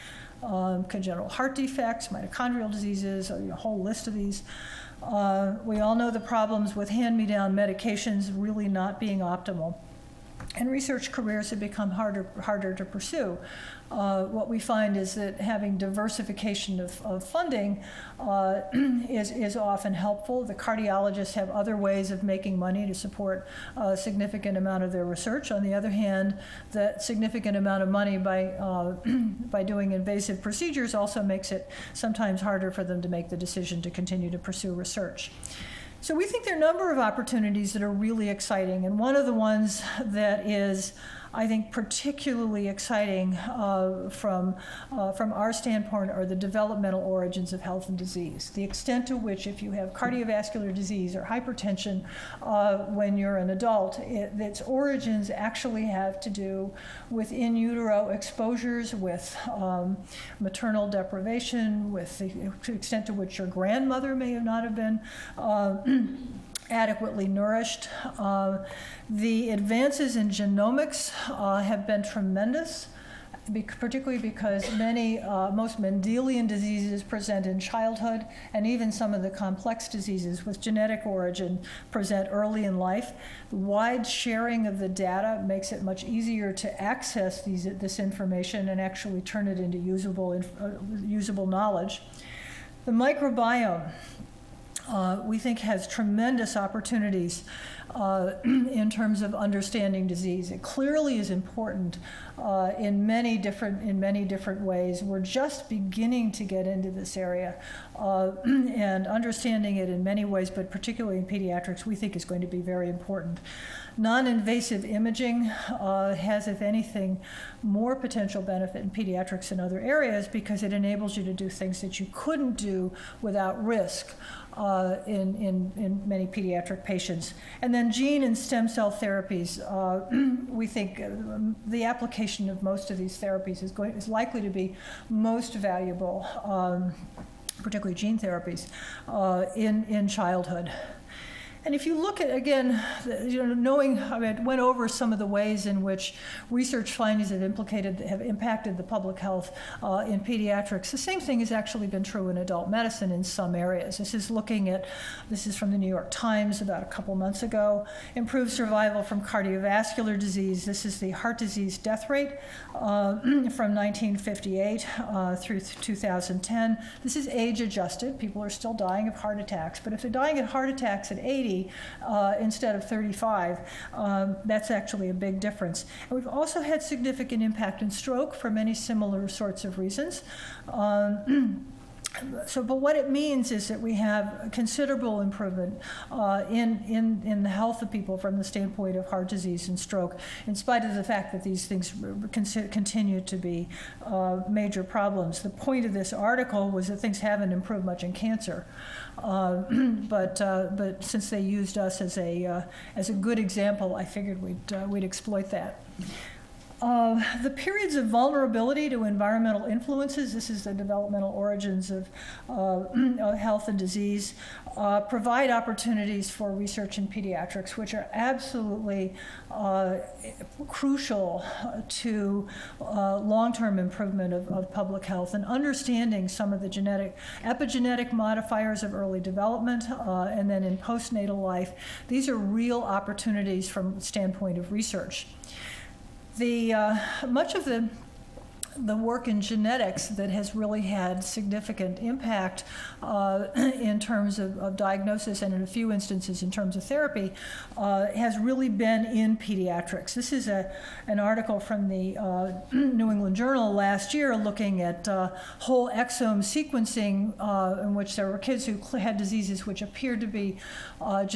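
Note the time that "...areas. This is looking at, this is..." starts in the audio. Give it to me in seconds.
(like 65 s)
153 s.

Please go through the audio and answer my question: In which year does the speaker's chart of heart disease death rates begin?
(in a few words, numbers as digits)
1958.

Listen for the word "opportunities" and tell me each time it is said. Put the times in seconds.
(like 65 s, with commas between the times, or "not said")
36 s, 96 s, 215 s, 232 s.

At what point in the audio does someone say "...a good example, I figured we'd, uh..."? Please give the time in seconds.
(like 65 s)
203 s.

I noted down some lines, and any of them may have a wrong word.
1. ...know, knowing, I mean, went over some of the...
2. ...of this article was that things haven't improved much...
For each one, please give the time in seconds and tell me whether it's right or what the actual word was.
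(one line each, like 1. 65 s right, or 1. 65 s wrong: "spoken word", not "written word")
1. 143 s right
2. 195 s right.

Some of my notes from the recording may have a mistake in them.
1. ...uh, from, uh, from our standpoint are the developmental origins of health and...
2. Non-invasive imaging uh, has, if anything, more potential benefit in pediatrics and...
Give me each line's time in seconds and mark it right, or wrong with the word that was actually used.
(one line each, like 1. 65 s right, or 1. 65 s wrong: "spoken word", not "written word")
1. 43 s right
2. 113 s right.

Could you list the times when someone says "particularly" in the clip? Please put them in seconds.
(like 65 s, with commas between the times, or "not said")
41 s, 73 s, 110 s, 137 s.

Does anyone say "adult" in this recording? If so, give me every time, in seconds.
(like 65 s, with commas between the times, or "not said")
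53 s, 152 s.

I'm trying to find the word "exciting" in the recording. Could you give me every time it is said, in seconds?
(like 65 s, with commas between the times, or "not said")
38 s, 42 s.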